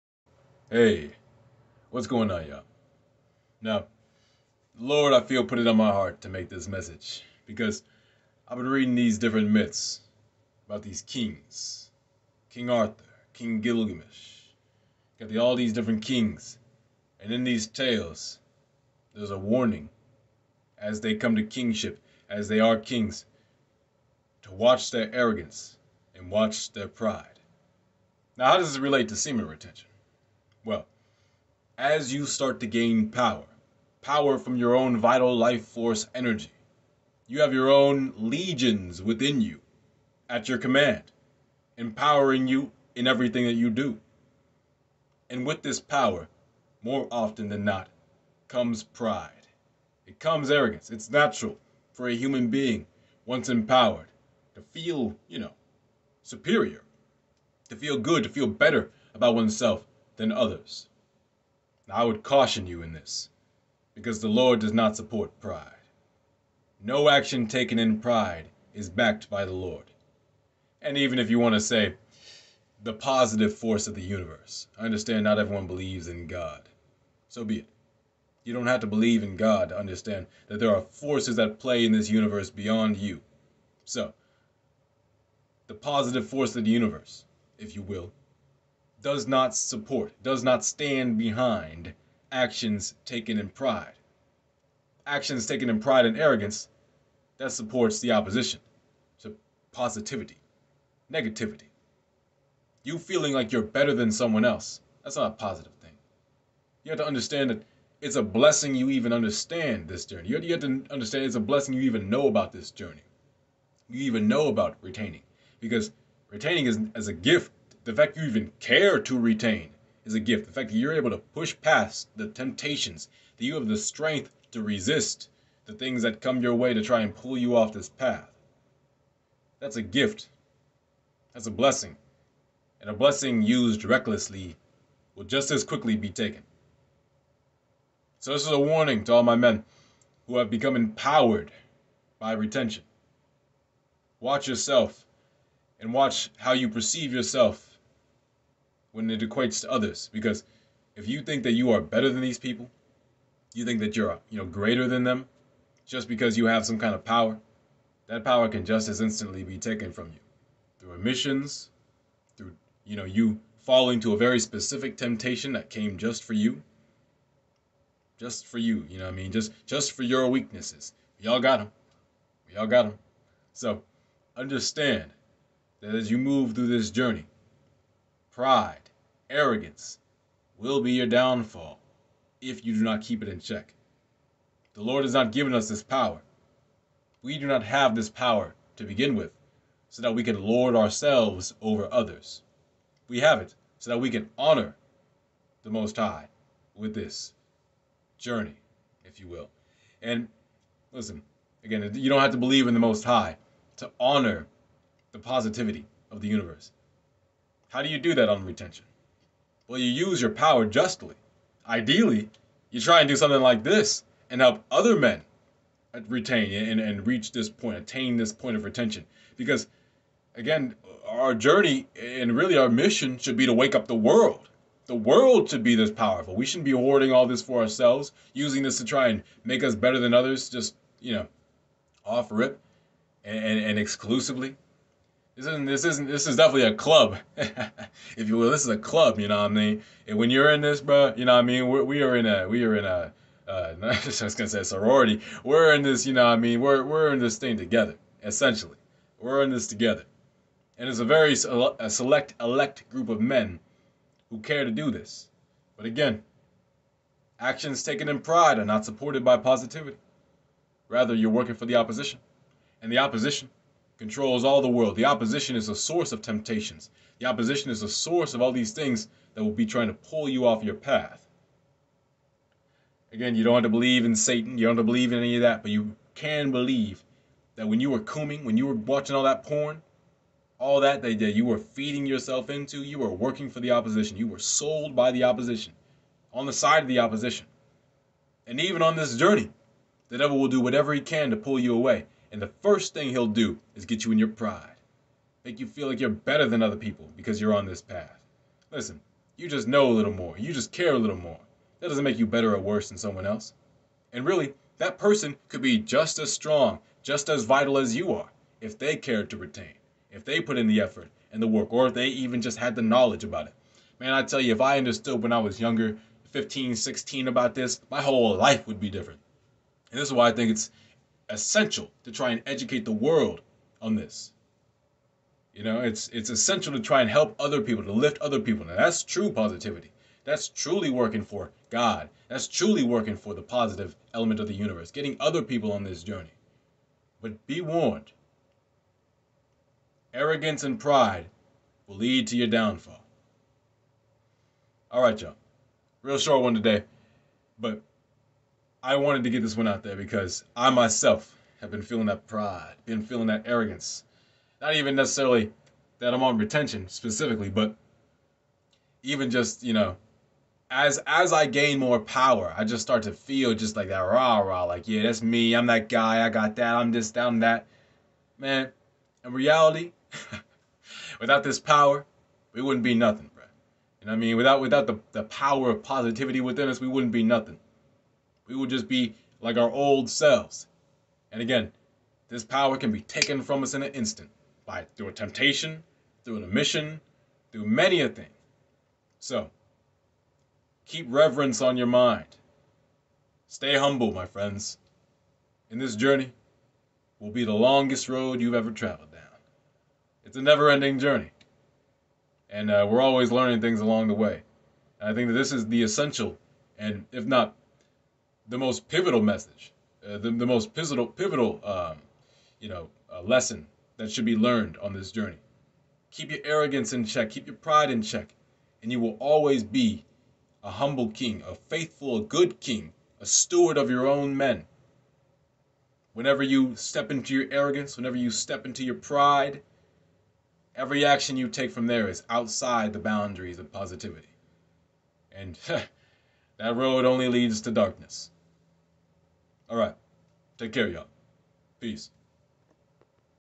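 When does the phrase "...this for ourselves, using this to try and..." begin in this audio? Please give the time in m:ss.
3:47.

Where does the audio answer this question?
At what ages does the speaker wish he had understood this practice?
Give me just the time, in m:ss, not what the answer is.
5:16.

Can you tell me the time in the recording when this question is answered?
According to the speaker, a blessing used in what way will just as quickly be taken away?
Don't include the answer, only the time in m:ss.
2:13.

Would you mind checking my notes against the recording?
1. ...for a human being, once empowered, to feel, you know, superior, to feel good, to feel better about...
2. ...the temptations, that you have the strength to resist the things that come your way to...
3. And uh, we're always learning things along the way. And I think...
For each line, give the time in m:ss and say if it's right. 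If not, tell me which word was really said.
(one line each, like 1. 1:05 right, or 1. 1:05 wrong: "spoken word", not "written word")
1. 0:51 right
2. 2:02 right
3. 6:42 right.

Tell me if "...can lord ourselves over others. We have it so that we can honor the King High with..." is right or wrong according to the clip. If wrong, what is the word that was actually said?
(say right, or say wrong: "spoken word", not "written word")
wrong: "Most", not "King".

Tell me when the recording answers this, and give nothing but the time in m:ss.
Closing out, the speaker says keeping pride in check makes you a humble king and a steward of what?
7:03.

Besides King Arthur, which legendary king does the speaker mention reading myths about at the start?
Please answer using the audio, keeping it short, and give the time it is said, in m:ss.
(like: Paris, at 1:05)
Gilgamesh, at 0:13.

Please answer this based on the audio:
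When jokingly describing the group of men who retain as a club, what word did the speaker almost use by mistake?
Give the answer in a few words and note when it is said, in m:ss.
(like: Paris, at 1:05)
Sorority, at 4:04.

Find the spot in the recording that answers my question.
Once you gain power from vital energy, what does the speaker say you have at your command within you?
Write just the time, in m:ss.
0:38.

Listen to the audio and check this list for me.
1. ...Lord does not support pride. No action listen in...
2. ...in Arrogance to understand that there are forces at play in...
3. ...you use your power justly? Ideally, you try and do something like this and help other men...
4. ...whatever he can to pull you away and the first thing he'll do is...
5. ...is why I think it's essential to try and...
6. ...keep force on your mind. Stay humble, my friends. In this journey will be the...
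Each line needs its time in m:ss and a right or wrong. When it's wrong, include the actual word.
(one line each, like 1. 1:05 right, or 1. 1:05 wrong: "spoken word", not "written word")
1. 1:04 wrong: "taken", not "listen"
2. 1:19 wrong: "God", not "Arrogance"
3. 3:29 right
4. 4:50 right
5. 5:20 right
6. 6:30 wrong: "reverence", not "force".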